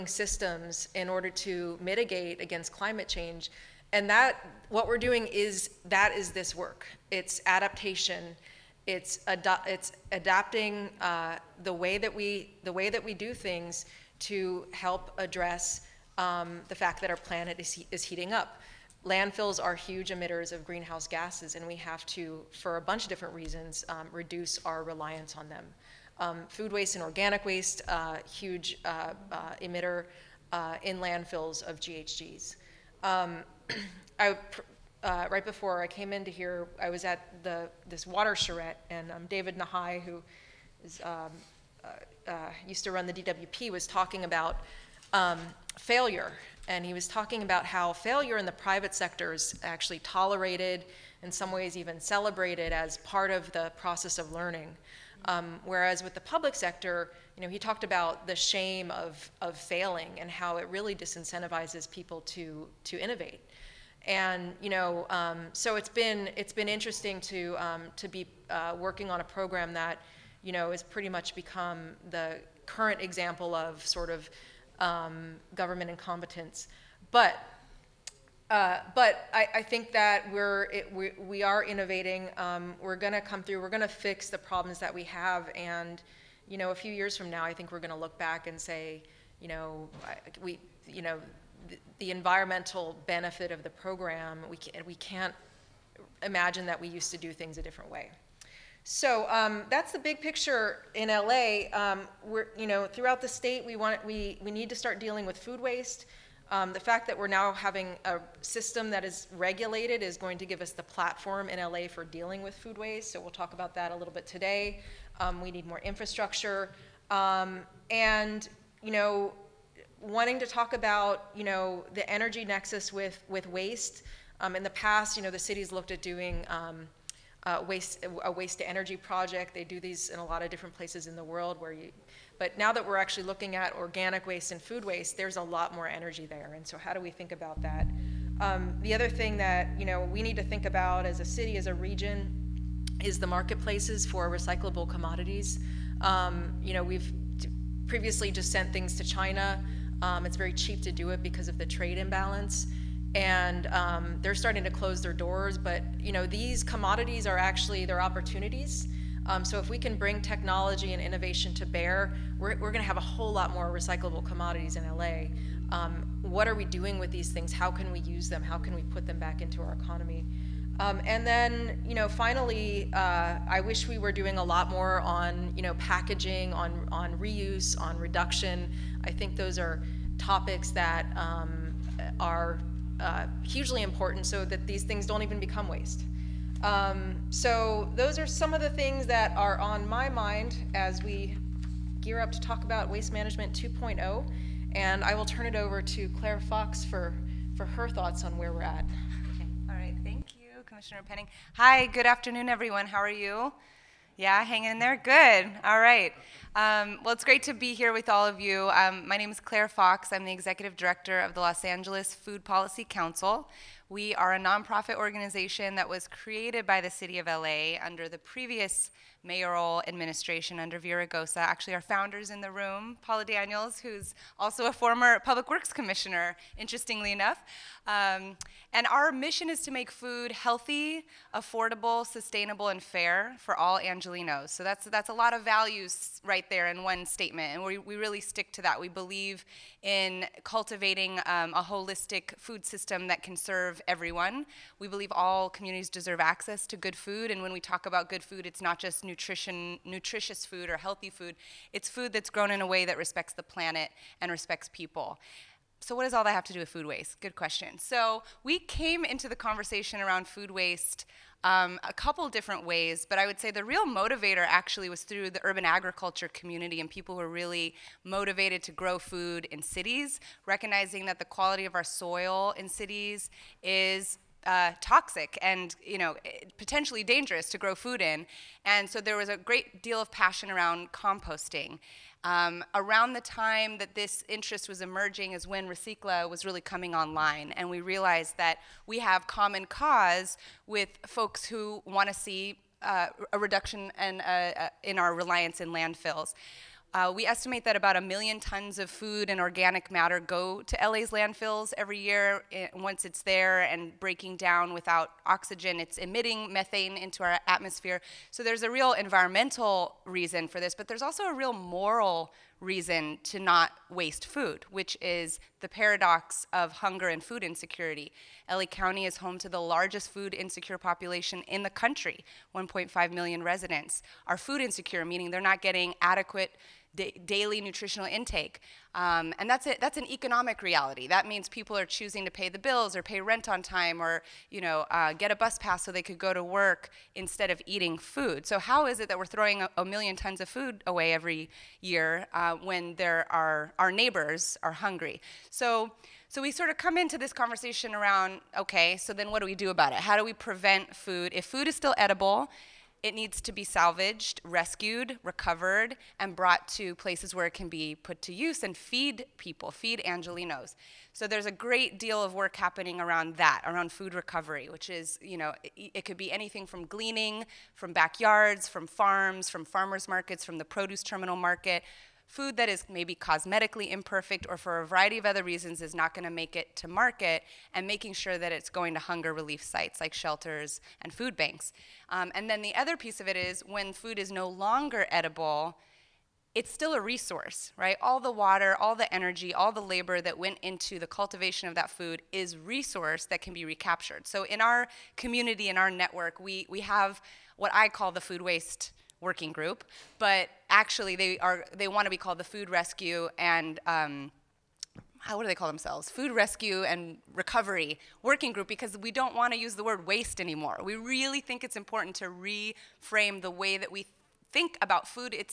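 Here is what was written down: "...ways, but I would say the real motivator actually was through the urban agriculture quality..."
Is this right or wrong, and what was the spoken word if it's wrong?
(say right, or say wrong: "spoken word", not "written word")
wrong: "community", not "quality".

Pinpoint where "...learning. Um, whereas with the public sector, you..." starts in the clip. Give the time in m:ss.
0:54.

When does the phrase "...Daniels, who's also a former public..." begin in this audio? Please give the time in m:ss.
3:43.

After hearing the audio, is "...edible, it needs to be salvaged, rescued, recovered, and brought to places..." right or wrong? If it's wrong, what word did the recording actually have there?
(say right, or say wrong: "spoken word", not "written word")
right.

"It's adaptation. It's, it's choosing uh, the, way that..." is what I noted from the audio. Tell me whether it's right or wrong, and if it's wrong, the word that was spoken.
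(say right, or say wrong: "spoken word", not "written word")
wrong: "adapting", not "choosing".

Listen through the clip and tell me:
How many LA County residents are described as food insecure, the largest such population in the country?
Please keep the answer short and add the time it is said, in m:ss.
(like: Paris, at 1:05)
1.5 million, at 5:22.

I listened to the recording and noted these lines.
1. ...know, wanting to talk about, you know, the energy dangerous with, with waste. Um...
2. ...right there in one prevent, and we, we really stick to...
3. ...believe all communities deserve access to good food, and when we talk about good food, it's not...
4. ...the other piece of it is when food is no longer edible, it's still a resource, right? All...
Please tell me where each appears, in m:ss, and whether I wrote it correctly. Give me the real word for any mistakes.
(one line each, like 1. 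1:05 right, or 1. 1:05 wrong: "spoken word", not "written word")
1. 1:58 wrong: "nexus", not "dangerous"
2. 3:56 wrong: "statement", not "prevent"
3. 4:04 right
4. 6:22 right.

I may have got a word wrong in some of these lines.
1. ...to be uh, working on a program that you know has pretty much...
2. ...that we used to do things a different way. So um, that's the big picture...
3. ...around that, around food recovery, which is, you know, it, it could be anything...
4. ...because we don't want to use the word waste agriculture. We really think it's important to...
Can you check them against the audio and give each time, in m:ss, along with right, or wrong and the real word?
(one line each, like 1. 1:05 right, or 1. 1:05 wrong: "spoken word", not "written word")
1. 1:07 right
2. 1:36 right
3. 6:03 right
4. 6:48 wrong: "anymore", not "agriculture".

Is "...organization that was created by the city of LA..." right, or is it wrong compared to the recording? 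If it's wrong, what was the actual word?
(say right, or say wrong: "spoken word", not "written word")
right.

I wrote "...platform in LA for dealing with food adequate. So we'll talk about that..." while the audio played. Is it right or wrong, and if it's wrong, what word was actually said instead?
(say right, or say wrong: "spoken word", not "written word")
wrong: "waste", not "adequate".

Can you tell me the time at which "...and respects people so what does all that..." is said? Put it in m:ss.
4:14.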